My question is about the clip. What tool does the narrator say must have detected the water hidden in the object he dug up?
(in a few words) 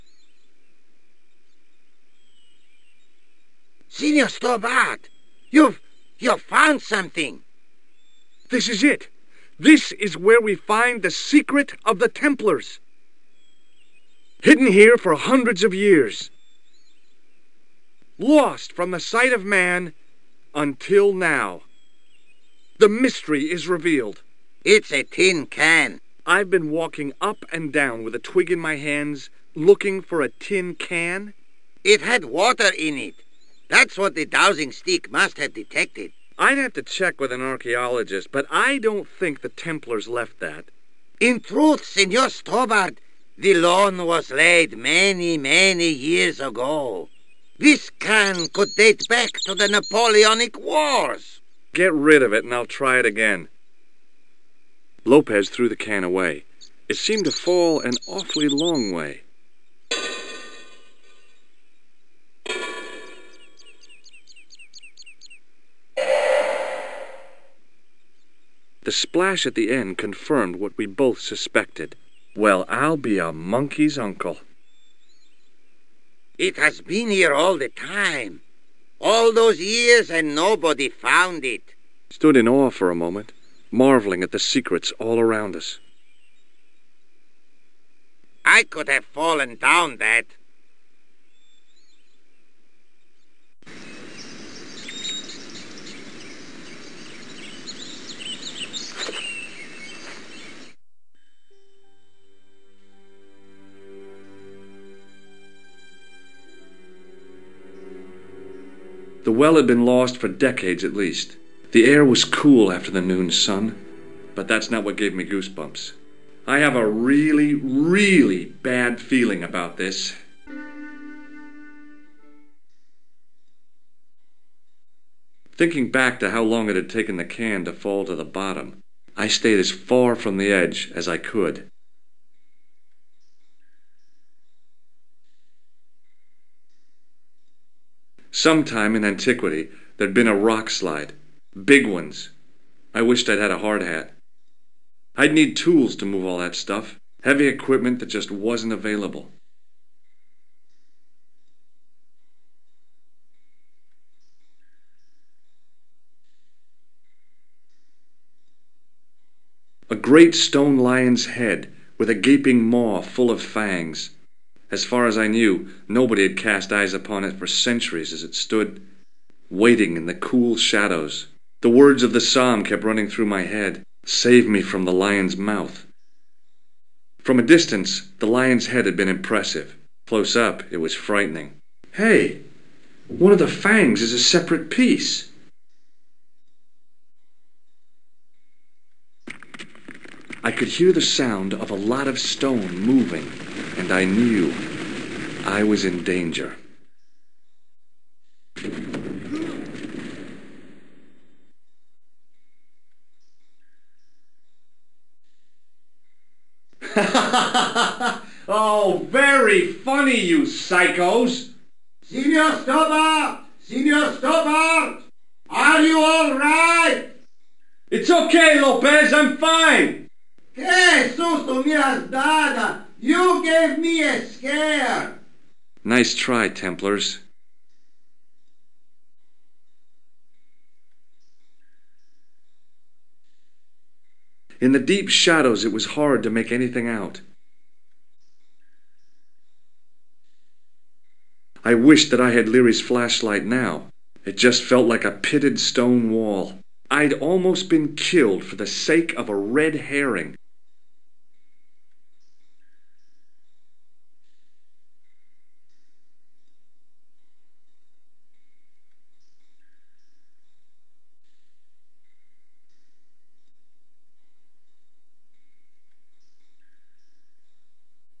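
Dowsing stick.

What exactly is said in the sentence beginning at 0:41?
In truth, Senor Stobart, the loan was laid many, many years ago.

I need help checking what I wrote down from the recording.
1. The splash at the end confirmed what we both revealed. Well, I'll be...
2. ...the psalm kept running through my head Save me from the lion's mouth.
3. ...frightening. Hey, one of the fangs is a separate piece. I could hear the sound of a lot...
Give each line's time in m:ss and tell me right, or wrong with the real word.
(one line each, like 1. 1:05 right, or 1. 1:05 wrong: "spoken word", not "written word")
1. 1:08 wrong: "suspected", not "revealed"
2. 2:52 right
3. 3:00 right.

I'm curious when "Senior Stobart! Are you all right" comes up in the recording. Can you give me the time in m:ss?
3:33.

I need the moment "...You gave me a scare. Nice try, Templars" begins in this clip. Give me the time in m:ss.
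3:42.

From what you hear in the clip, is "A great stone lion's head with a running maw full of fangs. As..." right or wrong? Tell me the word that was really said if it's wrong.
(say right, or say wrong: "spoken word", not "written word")
wrong: "gaping", not "running".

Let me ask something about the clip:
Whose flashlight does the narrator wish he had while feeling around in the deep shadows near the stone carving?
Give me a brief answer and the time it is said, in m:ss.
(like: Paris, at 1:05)
Leary's, at 4:02.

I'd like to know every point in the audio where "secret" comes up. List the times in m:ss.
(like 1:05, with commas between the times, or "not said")
0:11, 1:24.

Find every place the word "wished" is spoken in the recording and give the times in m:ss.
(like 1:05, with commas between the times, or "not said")
2:23, 4:01.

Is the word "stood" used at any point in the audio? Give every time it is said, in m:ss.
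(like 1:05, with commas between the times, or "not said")
1:22, 2:48.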